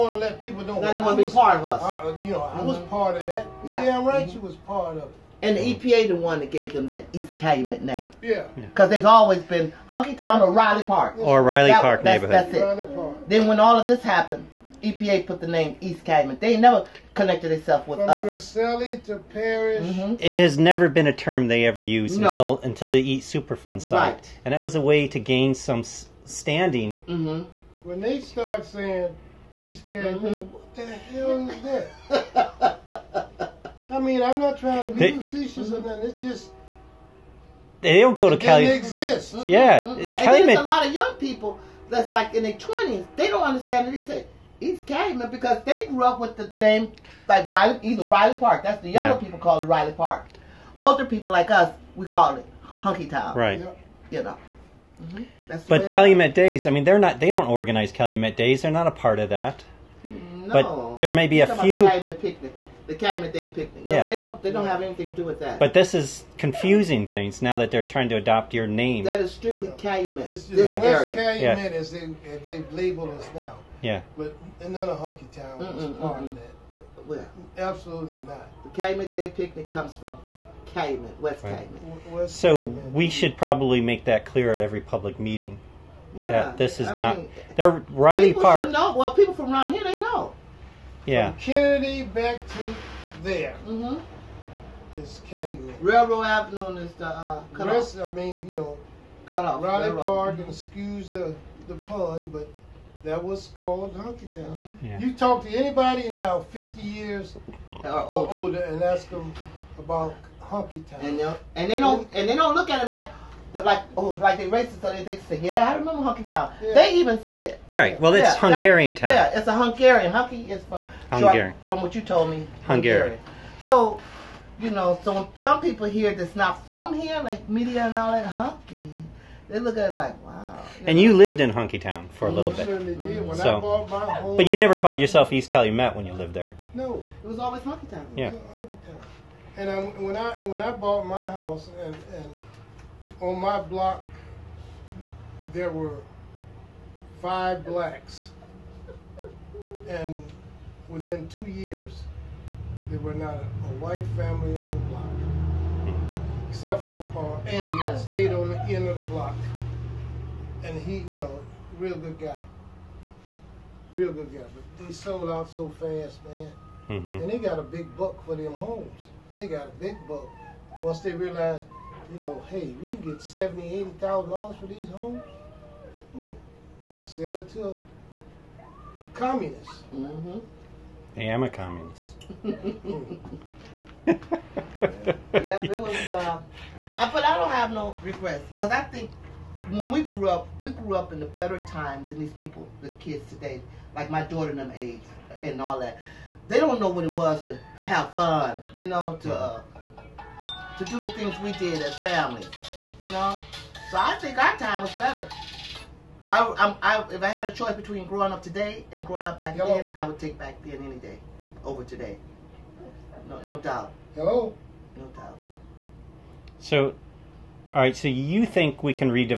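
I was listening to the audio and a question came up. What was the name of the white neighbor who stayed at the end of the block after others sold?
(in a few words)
Andy.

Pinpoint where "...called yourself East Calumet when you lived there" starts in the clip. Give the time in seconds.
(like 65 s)
134 s.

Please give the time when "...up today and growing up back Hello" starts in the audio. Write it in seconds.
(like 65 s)
208 s.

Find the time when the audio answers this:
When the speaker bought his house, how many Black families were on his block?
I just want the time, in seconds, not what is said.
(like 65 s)
147 s.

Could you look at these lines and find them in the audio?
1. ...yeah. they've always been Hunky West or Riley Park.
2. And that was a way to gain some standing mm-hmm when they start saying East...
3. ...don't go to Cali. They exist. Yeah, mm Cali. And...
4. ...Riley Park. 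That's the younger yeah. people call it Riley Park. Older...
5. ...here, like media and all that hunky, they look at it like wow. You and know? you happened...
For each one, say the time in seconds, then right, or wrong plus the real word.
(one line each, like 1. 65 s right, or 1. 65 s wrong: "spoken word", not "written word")
1. 8 s wrong: "Town", not "West"
2. 24 s right
3. 38 s right
4. 48 s right
5. 126 s wrong: "lived", not "happened".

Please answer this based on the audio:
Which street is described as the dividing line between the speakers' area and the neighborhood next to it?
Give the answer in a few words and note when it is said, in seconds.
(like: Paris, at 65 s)
Railroad Avenue, at 95 s.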